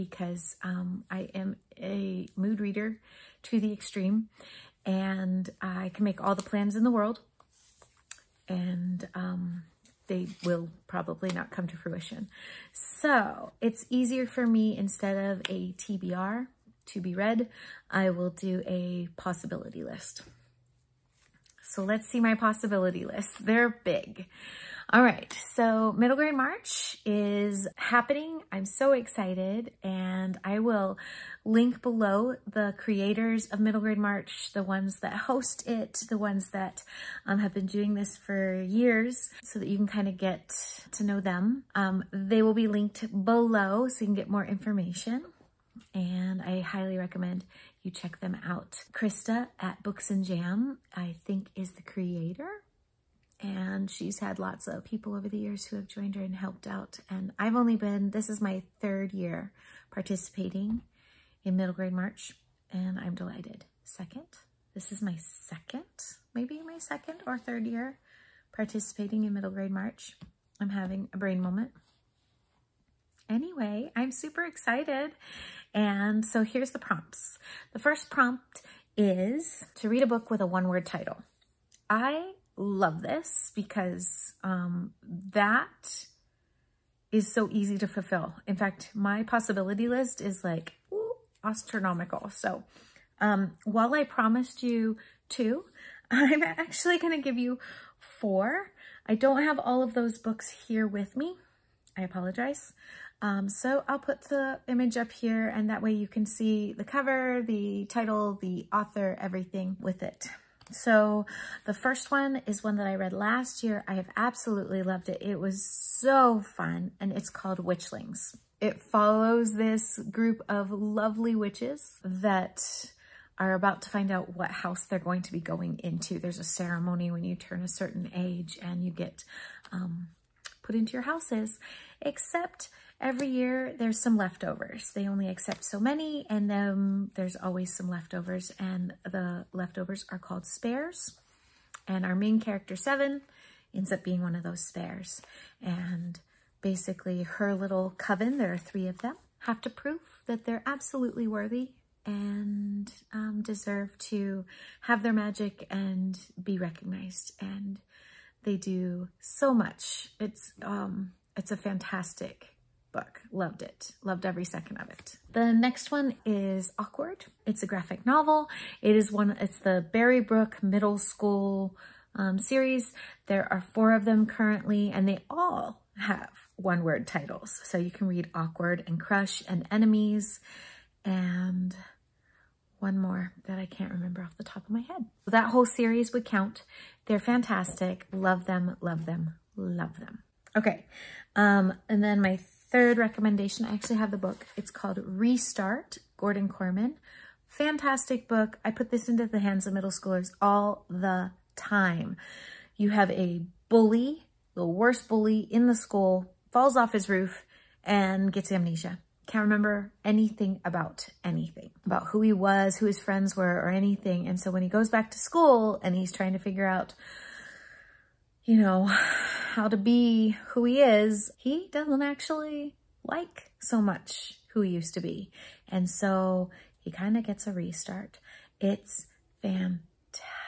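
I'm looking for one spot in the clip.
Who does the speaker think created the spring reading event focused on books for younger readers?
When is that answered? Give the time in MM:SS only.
00:48.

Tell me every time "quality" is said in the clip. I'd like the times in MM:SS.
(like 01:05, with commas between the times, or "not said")
not said.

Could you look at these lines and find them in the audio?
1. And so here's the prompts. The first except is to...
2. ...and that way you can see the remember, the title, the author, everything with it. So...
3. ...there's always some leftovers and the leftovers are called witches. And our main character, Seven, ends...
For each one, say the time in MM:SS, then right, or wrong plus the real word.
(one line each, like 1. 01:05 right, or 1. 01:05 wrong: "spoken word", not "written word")
1. 01:15 wrong: "prompt", not "except"
2. 01:45 wrong: "cover", not "remember"
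3. 02:17 wrong: "spares", not "witches".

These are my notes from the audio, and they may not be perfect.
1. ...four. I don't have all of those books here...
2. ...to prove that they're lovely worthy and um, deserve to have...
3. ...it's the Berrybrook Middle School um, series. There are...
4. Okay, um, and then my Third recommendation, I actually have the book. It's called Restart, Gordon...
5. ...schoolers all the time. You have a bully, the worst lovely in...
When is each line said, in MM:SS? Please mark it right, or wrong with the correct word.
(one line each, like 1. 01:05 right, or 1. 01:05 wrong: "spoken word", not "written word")
1. 01:37 right
2. 02:29 wrong: "absolutely", not "lovely"
3. 02:49 right
4. 03:10 right
5. 03:19 wrong: "bully", not "lovely".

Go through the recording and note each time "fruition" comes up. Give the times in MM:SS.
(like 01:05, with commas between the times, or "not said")
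00:11.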